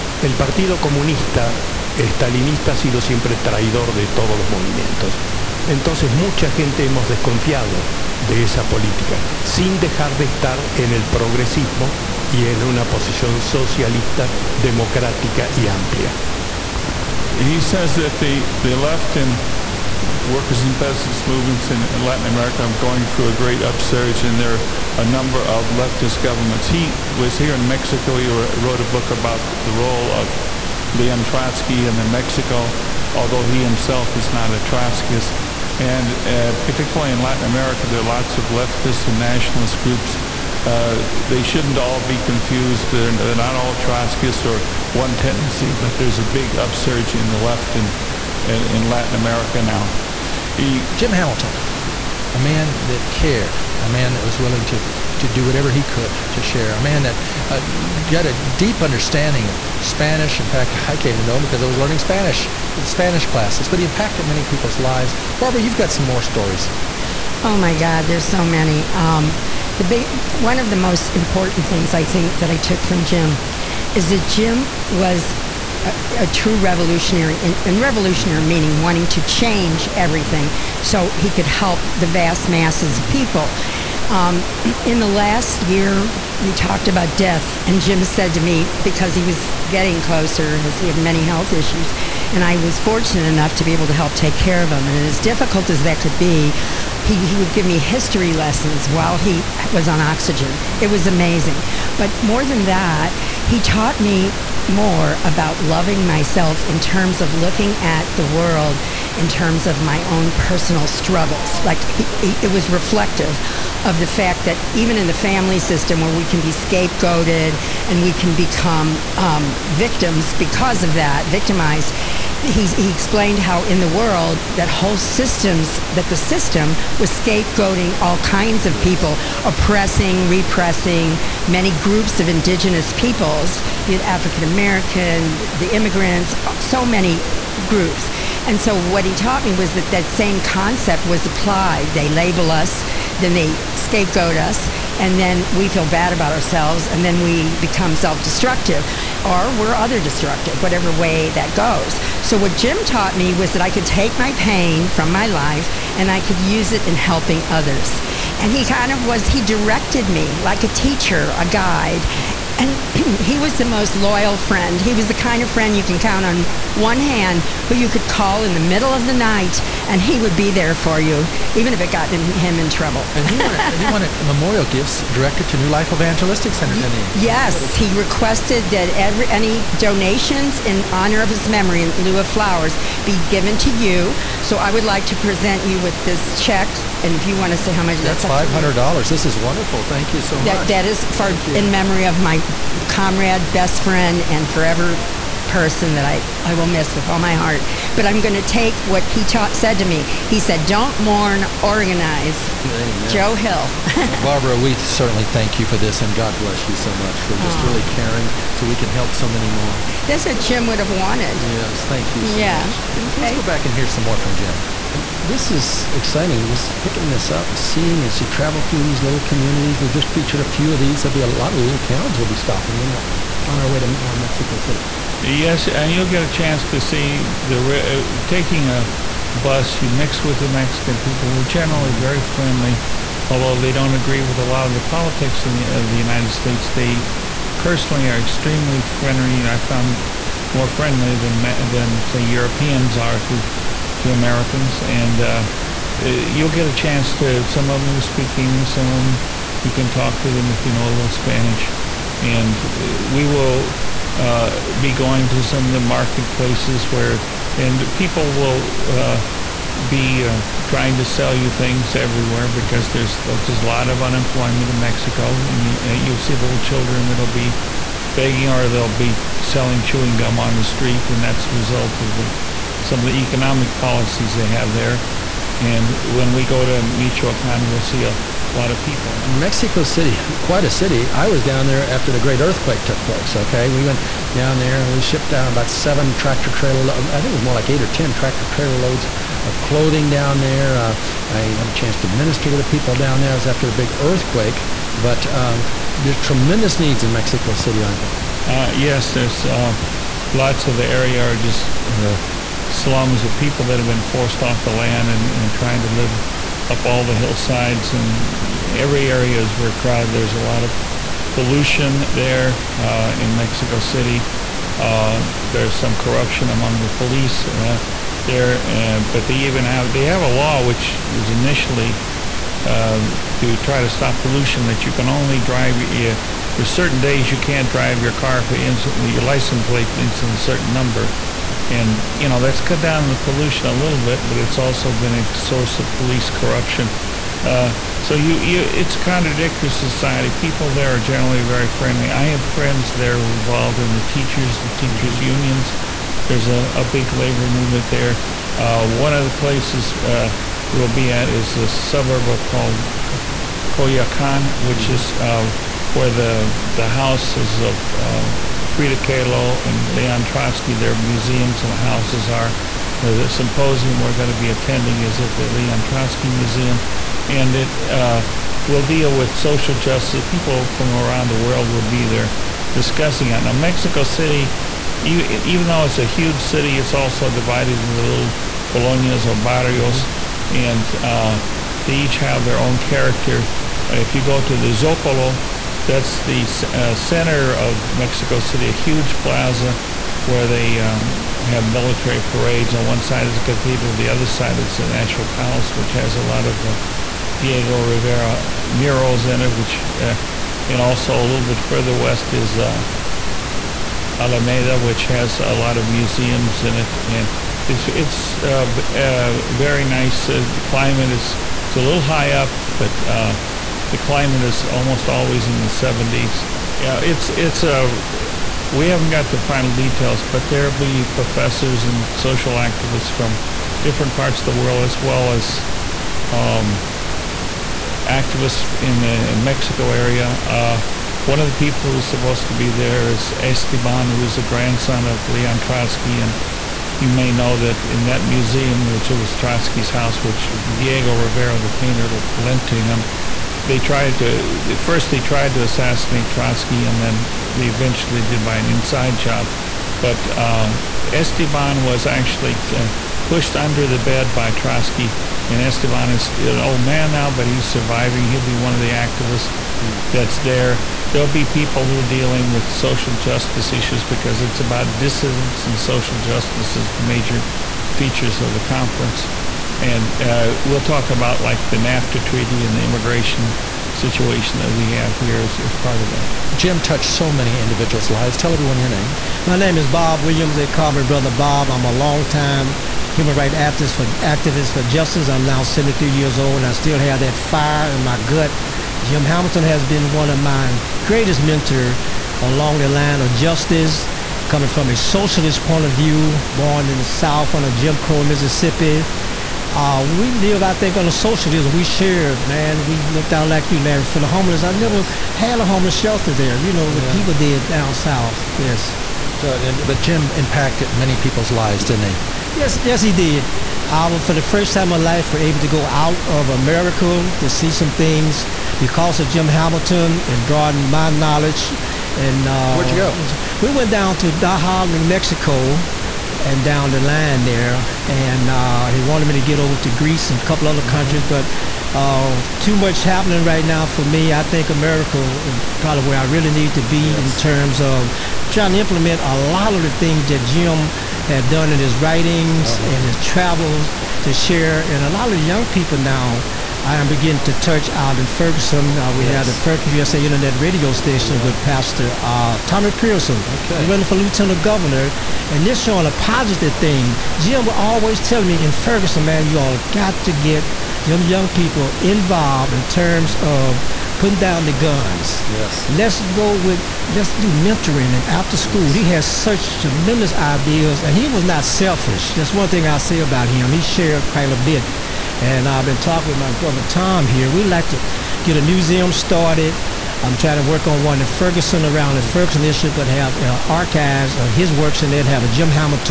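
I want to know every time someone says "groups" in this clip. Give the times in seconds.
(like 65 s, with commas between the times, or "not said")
39 s, 131 s, 137 s.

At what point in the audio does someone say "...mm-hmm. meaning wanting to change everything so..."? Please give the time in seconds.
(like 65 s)
78 s.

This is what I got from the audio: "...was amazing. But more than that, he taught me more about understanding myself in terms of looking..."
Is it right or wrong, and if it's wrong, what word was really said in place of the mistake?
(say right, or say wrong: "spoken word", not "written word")
wrong: "loving", not "understanding".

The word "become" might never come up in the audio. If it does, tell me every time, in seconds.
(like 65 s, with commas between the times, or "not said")
118 s, 147 s.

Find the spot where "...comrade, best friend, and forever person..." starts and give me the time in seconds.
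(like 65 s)
192 s.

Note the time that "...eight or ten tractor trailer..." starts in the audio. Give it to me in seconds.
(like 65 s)
287 s.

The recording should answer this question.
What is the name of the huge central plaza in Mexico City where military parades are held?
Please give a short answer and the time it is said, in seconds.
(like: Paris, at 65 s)
Zocalo, at 384 s.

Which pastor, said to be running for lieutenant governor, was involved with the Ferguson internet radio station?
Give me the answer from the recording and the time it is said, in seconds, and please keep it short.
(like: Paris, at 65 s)
Tommie Pierson, at 552 s.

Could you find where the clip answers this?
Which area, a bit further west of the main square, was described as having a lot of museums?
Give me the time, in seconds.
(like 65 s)
404 s.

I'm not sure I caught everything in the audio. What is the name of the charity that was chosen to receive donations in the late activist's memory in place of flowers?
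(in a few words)
New Life Evangelistic Center.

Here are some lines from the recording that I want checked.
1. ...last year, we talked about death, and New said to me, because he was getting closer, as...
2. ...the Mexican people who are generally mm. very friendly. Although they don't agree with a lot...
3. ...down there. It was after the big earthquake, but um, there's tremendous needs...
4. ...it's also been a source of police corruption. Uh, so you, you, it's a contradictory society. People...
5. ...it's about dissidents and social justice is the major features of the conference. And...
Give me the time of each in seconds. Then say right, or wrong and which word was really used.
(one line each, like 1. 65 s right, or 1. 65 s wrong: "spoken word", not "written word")
1. 85 s wrong: "Jim", not "New"
2. 230 s right
3. 292 s right
4. 334 s right
5. 464 s right.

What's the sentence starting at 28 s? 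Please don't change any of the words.
He wrote a book about the role of Leon Trotsky in Mexico, although he himself is not a Trotskyist.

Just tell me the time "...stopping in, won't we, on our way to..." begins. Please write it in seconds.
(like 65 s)
222 s.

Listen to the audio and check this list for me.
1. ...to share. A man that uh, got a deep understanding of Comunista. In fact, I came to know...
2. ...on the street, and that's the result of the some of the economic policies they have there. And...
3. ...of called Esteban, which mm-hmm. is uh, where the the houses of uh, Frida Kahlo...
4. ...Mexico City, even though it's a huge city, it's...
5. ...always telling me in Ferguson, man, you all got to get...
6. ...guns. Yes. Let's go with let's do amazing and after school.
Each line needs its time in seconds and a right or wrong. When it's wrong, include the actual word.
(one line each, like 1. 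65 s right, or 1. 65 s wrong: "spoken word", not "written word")
1. 56 s wrong: "Spanish", not "Comunista"
2. 270 s right
3. 352 s wrong: "Coyoacán", not "Esteban"
4. 373 s right
5. 557 s right
6. 564 s wrong: "mentoring", not "amazing".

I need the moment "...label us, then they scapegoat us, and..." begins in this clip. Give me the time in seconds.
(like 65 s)
142 s.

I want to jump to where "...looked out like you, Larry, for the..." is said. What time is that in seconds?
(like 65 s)
503 s.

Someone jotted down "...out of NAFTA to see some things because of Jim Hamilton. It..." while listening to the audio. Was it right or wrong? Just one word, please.
wrong.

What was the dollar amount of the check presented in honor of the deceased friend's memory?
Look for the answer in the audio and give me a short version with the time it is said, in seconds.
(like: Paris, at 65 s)
$500, at 188 s.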